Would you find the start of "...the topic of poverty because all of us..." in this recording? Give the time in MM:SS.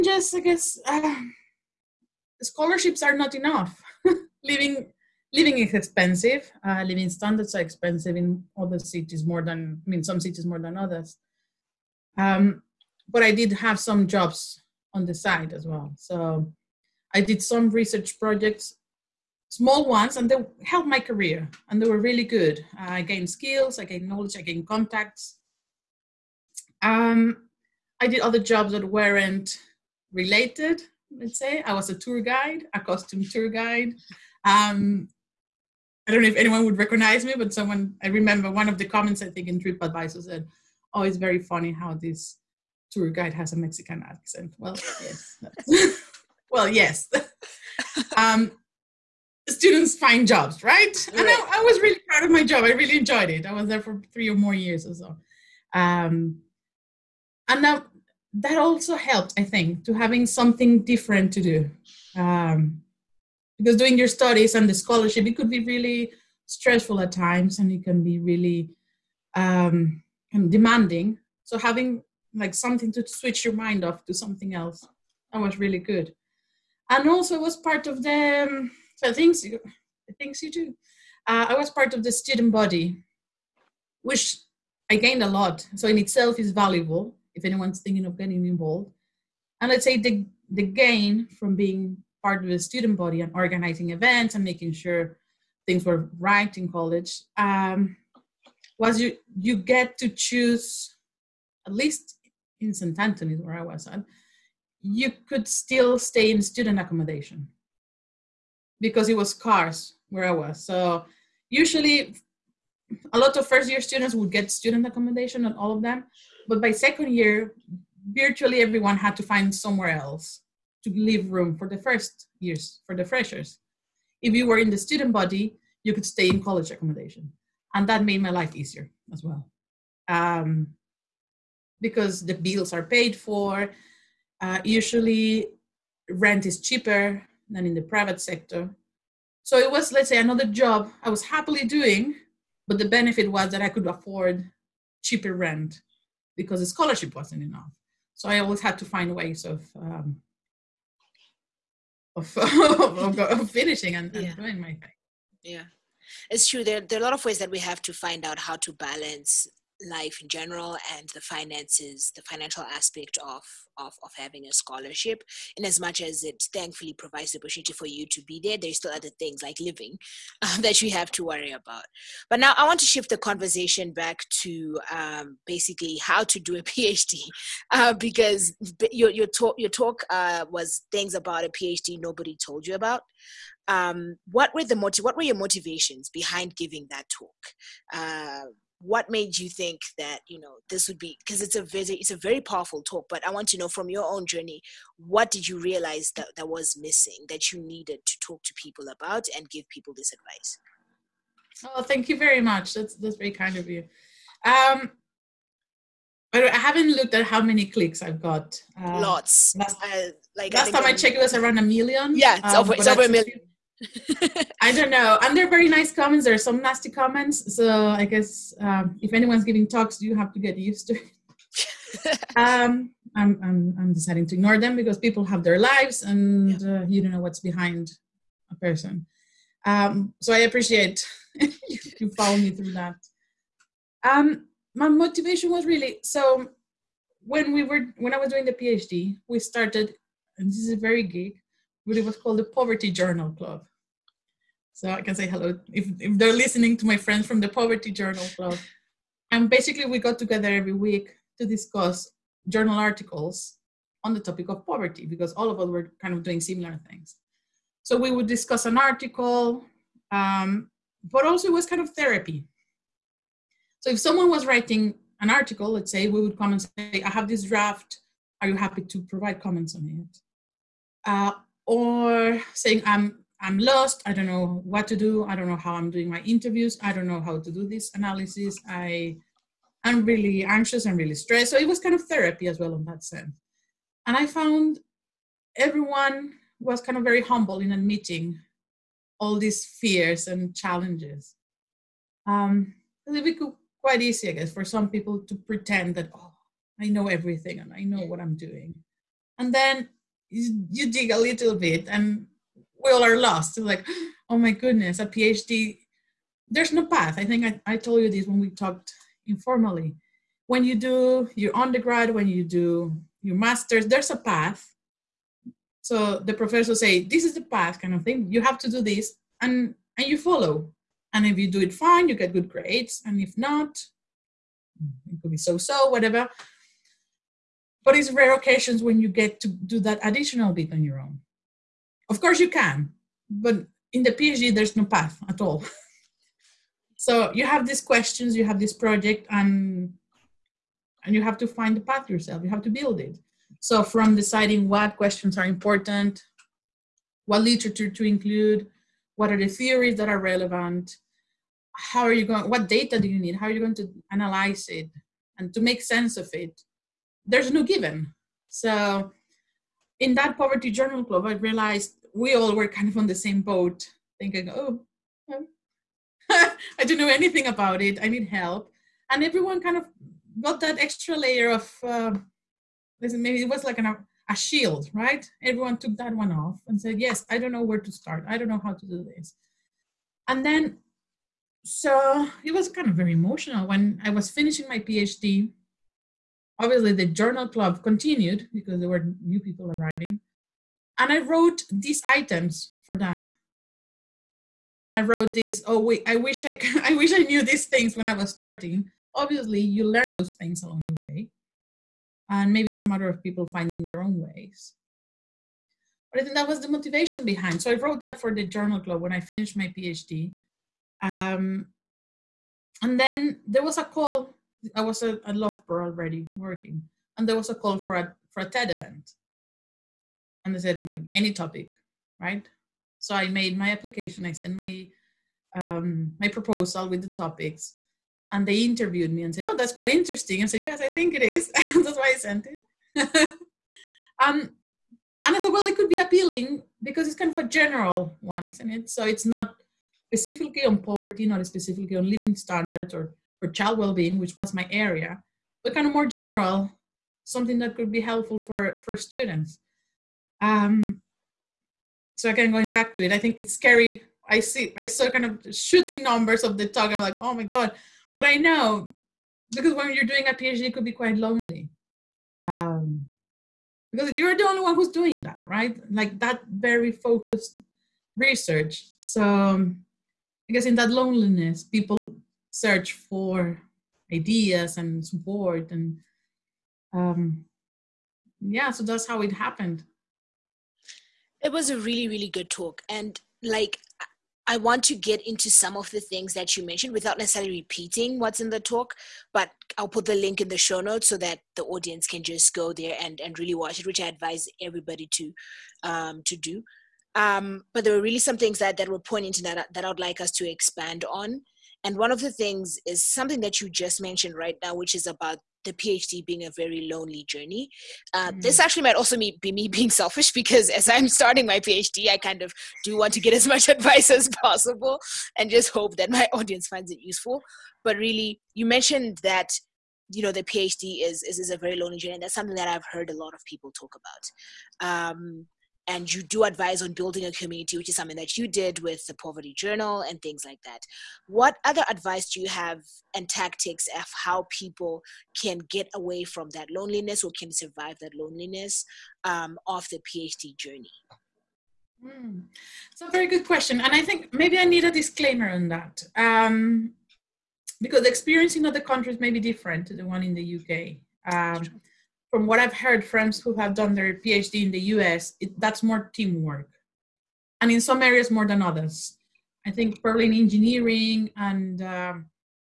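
04:14.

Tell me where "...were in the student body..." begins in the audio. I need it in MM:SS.
02:04.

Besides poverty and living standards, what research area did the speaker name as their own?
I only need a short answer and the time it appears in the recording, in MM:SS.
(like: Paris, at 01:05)
Child well-being, at 07:23.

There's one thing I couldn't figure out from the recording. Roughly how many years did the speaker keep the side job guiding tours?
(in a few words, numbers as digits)
3.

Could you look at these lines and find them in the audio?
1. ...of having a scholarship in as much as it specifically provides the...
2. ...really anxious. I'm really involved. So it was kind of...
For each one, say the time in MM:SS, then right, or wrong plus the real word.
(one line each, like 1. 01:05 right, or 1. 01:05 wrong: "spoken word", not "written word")
1. 02:44 wrong: "thankfully", not "specifically"
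2. 04:40 wrong: "stressed", not "involved".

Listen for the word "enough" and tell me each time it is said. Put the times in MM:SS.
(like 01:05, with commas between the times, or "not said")
00:03, 02:27.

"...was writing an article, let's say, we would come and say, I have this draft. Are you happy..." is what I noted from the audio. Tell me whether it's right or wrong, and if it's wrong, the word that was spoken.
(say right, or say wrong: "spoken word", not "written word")
right.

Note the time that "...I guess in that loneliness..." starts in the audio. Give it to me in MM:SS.
07:50.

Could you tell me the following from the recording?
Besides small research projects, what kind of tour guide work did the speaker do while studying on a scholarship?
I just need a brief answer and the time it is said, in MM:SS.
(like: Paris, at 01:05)
Costume tour guide, at 00:32.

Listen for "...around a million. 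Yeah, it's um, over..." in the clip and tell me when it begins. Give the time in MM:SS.
03:31.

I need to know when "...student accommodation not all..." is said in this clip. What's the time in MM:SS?
01:54.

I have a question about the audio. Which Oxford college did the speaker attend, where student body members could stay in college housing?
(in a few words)
St. Antony's.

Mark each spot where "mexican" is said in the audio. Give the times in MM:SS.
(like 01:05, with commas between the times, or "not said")
00:43.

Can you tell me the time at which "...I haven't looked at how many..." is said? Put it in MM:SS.
03:26.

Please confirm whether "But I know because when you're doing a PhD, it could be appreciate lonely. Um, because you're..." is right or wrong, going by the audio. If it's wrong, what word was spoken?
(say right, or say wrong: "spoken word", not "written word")
wrong: "quite", not "appreciate".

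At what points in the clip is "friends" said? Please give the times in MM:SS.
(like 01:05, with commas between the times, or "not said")
04:06, 09:13.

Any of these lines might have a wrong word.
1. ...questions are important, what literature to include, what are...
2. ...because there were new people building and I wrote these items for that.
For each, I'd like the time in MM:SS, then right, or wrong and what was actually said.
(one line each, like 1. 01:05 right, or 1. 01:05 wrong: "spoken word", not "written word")
1. 05:44 right
2. 06:28 wrong: "arriving", not "building".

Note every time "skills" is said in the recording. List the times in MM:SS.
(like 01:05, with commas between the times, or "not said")
00:23.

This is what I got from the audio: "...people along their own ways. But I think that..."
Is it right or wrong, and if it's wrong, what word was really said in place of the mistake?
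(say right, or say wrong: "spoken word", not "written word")
wrong: "finding", not "along".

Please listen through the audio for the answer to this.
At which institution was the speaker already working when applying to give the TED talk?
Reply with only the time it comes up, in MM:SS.
06:55.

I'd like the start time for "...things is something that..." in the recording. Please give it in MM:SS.
08:22.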